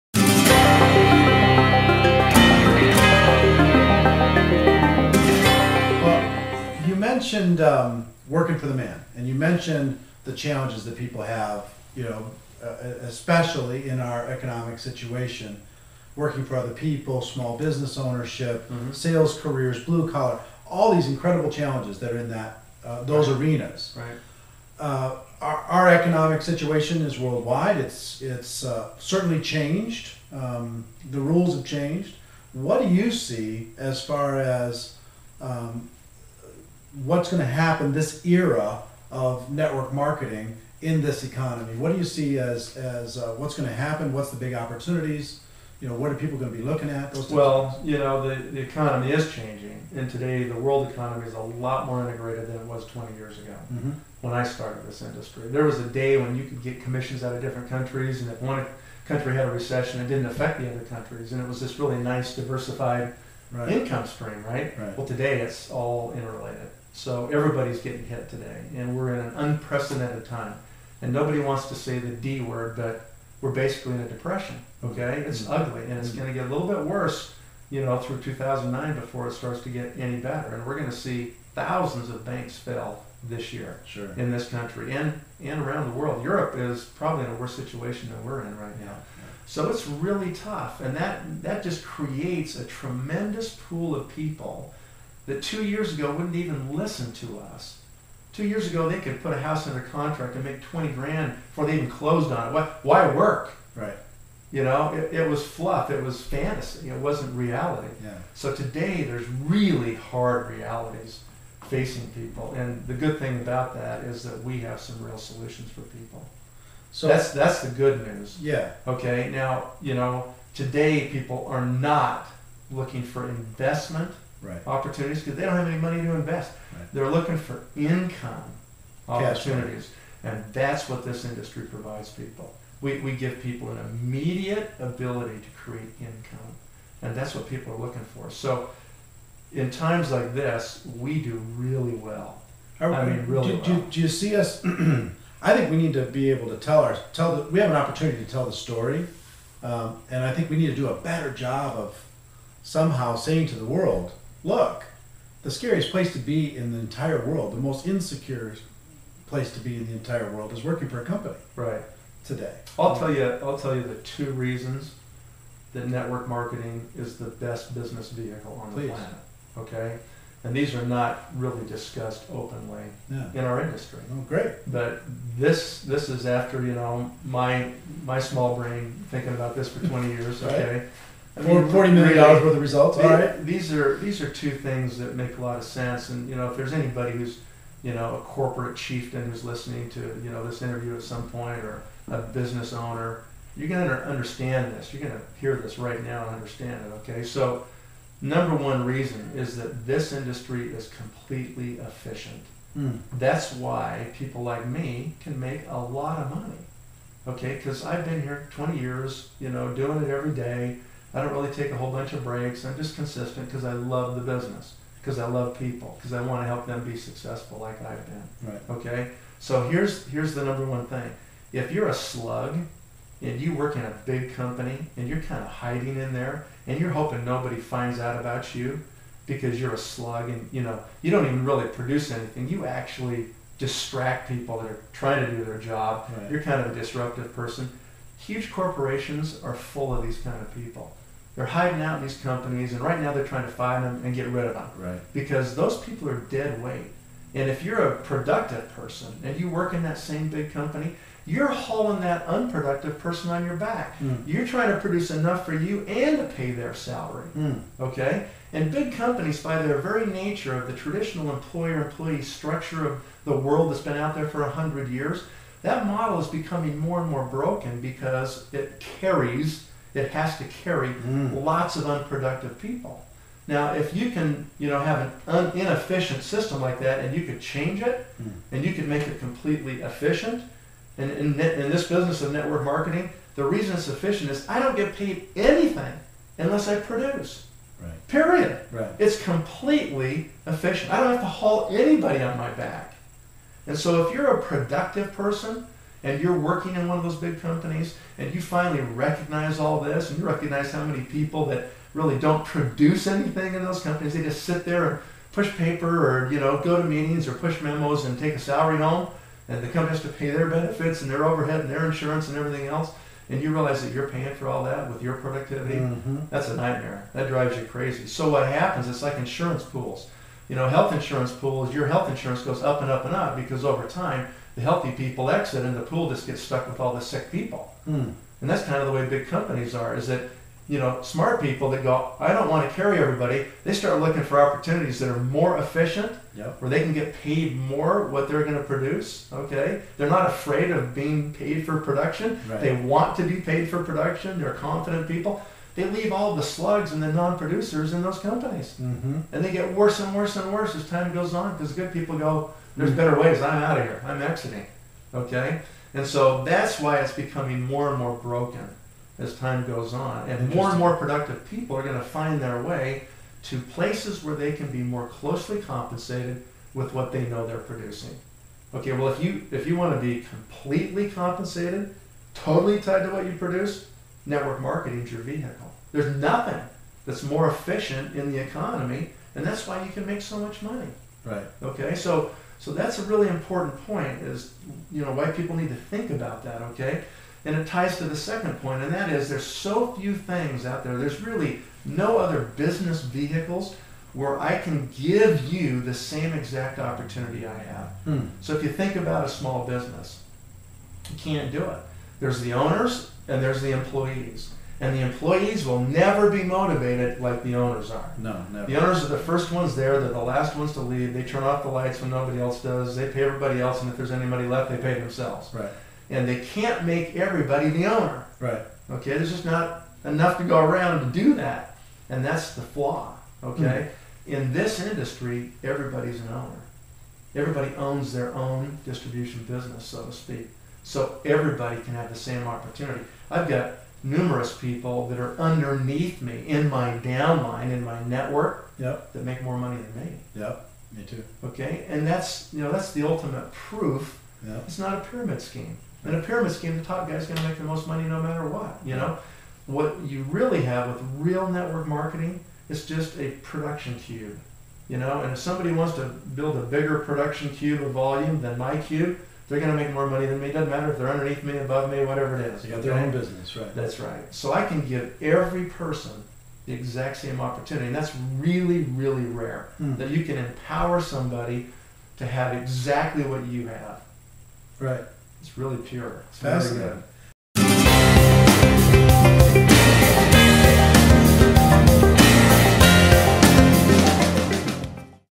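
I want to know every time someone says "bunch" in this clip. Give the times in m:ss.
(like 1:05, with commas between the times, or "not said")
3:31.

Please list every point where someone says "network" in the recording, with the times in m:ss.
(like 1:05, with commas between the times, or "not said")
0:39, 2:45, 4:42, 6:14, 7:18, 7:31.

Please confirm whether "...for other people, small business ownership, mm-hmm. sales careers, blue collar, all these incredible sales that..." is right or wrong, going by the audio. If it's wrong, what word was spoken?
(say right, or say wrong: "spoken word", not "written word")
wrong: "challenges", not "sales".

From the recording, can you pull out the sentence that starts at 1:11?
And nobody wants to say the D word, but we're basically in a depression.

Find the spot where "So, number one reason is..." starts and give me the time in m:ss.
3:17.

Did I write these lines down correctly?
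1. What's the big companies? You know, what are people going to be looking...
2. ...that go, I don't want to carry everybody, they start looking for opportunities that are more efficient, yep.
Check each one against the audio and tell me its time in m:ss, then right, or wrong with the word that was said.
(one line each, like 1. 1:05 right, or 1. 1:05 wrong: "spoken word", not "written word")
1. 0:44 wrong: "opportunities", not "companies"
2. 5:31 right.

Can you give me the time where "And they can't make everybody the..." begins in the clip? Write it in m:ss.
6:56.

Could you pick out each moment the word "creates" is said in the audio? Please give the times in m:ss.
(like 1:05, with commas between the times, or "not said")
1:31, 2:15.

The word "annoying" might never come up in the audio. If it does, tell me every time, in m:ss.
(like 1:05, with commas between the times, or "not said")
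not said.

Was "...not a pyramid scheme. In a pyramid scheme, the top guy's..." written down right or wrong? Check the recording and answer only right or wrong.
right.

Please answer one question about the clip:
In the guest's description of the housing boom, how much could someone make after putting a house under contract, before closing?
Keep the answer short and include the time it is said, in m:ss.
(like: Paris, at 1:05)
20 grand, at 1:40.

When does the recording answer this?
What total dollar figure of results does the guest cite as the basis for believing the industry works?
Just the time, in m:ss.
3:01.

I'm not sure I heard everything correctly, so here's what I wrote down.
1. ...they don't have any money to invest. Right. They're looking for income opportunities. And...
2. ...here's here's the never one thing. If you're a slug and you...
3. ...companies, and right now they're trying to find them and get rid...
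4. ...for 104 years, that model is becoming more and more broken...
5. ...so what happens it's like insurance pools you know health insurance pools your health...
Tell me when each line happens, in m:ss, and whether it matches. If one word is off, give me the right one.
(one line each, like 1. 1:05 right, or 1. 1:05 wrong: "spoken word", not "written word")
1. 2:05 right
2. 3:39 wrong: "number", not "never"
3. 4:02 right
4. 4:24 wrong: "100", not "104"
5. 5:18 right.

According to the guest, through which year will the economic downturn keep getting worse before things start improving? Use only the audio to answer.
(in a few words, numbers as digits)
2009.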